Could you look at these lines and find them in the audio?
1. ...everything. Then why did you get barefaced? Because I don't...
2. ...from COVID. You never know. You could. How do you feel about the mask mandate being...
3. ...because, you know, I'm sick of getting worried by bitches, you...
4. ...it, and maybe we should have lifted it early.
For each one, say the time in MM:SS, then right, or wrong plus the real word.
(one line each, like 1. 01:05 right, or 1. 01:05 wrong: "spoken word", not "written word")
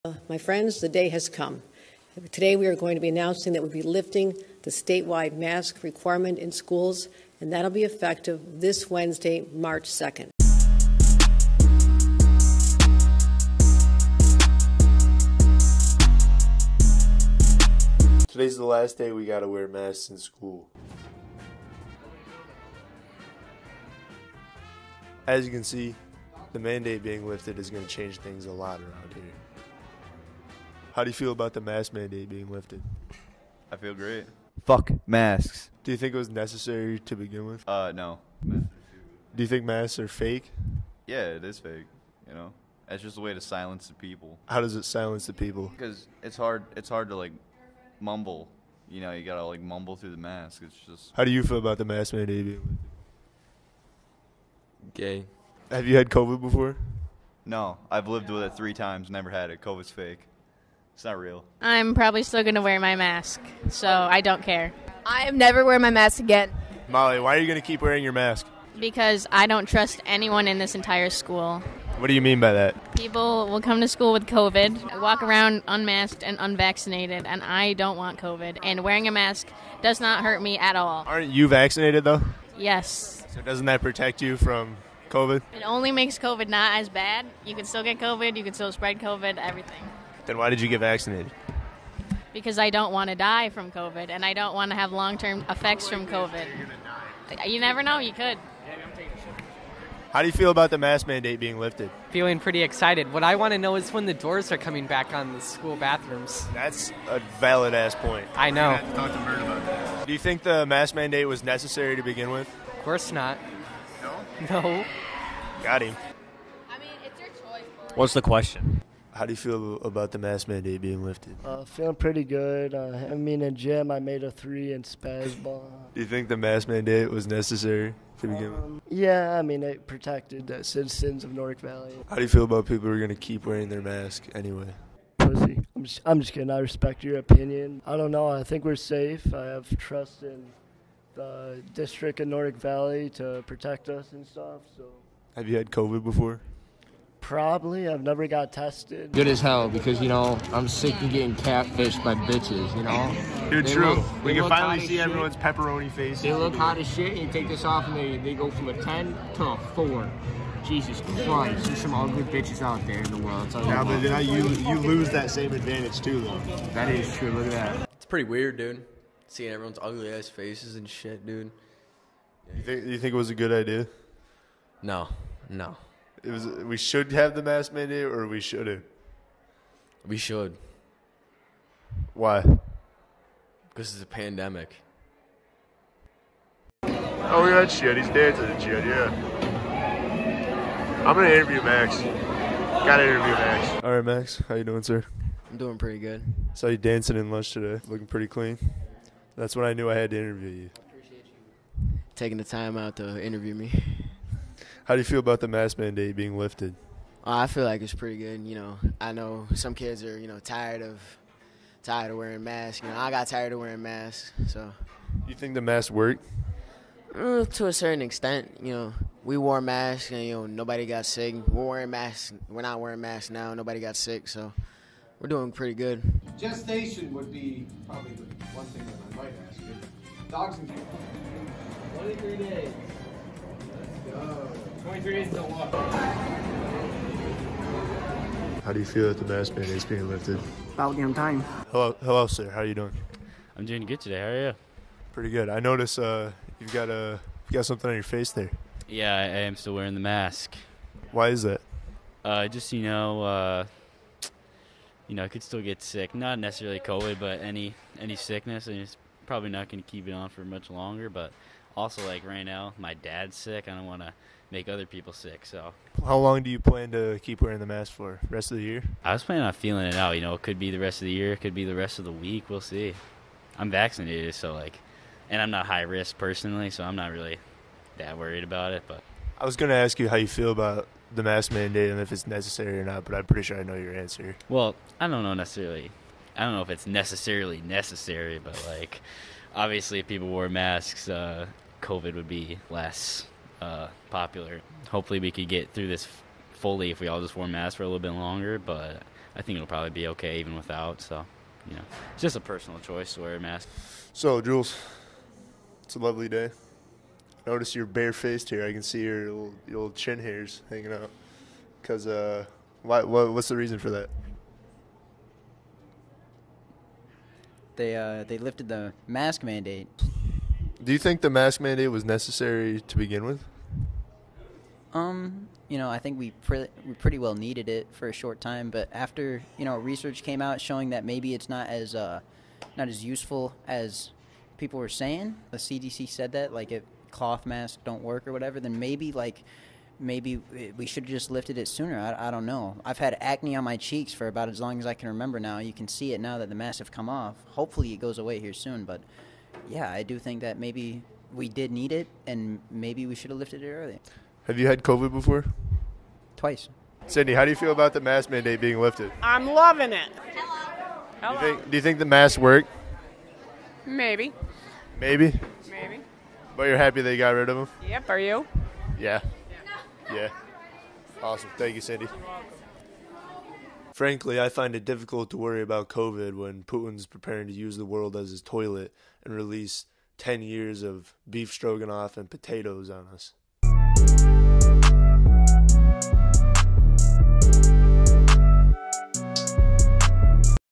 1. 01:29 wrong: "vaccinated", not "barefaced"
2. 01:35 right
3. 02:29 wrong: "catfished", not "worried"
4. 05:51 right.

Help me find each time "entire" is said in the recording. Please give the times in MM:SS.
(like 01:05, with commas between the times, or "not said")
01:10.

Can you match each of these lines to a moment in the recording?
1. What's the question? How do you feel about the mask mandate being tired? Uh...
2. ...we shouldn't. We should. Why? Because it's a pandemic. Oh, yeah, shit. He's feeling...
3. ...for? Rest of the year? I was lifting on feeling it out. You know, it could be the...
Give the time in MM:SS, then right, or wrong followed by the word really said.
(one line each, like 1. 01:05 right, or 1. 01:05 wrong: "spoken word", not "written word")
1. 01:57 wrong: "lifted", not "tired"
2. 02:58 wrong: "dancing", not "feeling"
3. 04:27 wrong: "planning", not "lifting".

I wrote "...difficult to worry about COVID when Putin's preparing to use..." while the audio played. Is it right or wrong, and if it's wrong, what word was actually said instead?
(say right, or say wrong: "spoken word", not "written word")
right.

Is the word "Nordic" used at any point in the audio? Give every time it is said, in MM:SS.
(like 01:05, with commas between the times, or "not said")
02:11, 02:22.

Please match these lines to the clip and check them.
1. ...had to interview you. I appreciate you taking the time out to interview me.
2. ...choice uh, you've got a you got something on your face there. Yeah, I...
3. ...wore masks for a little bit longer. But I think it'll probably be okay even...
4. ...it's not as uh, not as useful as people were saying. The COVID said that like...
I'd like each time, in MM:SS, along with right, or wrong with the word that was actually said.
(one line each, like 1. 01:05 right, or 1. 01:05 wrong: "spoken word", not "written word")
1. 03:19 right
2. 04:05 wrong: "notice", not "choice"
3. 04:57 right
4. 05:31 wrong: "CDC", not "COVID".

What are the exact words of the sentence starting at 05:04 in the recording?
So, Jules, it's a lovely day.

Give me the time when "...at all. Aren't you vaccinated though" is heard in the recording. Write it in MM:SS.
01:20.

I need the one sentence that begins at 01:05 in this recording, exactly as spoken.
I am never wearing my mask again.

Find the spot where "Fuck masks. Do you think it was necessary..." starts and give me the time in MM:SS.
00:34.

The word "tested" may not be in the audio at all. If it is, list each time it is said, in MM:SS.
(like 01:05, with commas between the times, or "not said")
02:28.